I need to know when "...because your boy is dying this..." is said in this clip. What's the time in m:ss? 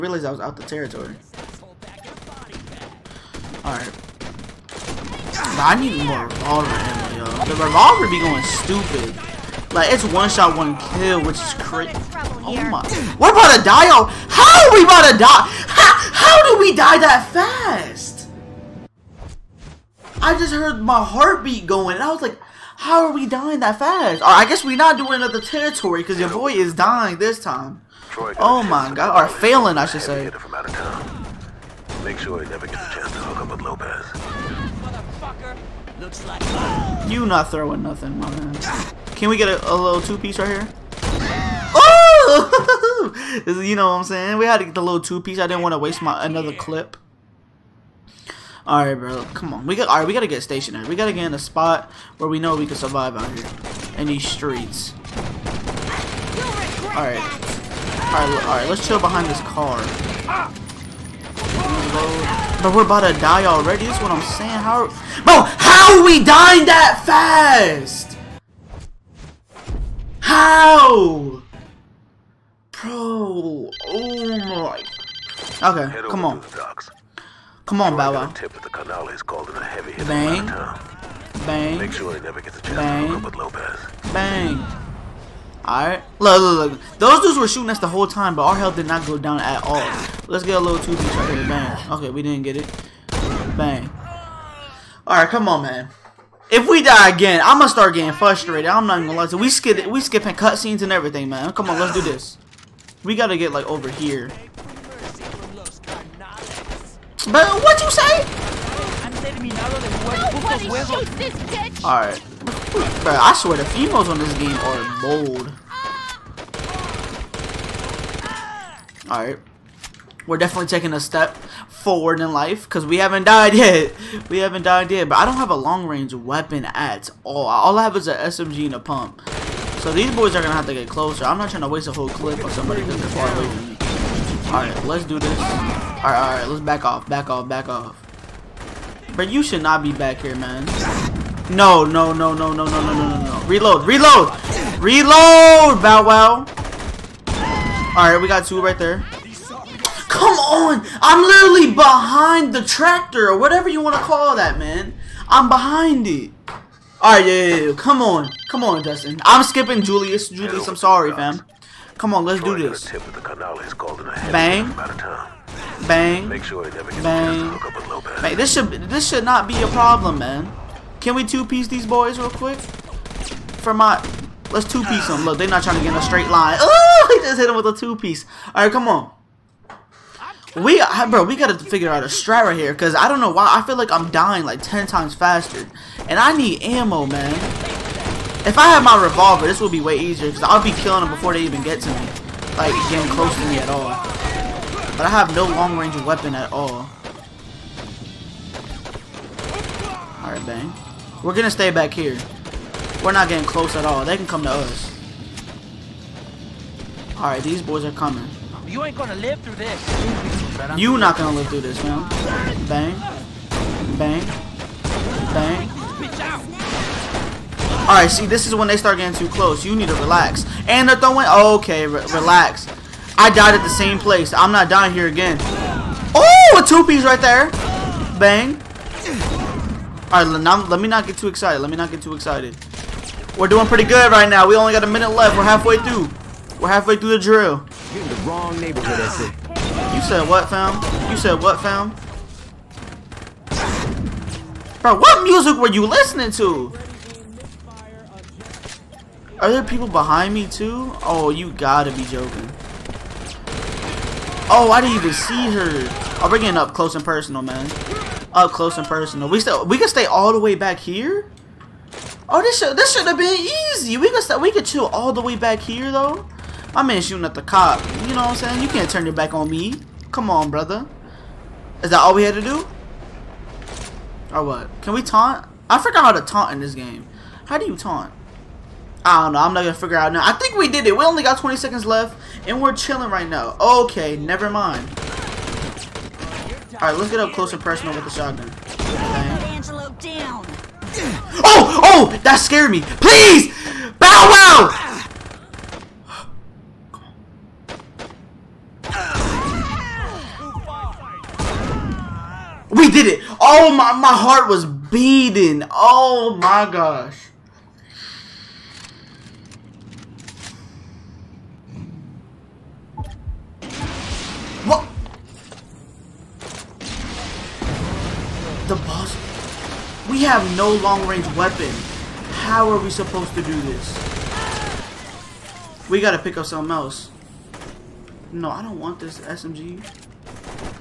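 0:26.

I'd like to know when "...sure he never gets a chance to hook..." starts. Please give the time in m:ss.
0:32.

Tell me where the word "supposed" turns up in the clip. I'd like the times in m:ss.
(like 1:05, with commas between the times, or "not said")
5:22.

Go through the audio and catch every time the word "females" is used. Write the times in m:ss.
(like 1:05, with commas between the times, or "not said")
1:53.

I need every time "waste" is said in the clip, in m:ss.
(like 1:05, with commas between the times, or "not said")
0:45, 2:11.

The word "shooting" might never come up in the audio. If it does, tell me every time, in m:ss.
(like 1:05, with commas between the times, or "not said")
1:27, 4:27.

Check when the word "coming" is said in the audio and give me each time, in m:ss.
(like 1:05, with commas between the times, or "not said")
3:27.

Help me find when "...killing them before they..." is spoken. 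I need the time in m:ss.
3:10.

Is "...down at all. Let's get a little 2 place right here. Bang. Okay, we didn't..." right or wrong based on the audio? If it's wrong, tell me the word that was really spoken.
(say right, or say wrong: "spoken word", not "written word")
wrong: "piece", not "place".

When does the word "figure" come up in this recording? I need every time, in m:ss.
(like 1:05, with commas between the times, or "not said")
3:01, 4:39.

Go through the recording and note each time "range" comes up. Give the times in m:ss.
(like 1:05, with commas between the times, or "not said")
2:05, 3:15, 5:20.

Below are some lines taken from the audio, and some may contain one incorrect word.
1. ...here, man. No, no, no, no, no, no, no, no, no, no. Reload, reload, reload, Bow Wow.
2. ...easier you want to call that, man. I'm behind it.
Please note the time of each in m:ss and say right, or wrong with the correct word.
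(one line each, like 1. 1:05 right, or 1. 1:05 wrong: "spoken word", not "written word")
1. 2:20 right
2. 2:33 wrong: "whatever", not "easier".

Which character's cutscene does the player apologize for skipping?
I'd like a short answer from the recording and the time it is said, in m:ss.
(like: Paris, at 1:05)
Julius, at 2:40.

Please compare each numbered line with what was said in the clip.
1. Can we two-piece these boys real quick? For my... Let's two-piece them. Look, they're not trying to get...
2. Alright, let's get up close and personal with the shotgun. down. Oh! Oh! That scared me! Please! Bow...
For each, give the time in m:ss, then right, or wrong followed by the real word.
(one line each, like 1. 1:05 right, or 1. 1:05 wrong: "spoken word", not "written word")
1. 2:51 right
2. 4:46 right.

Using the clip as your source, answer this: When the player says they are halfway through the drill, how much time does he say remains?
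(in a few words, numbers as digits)
a minute.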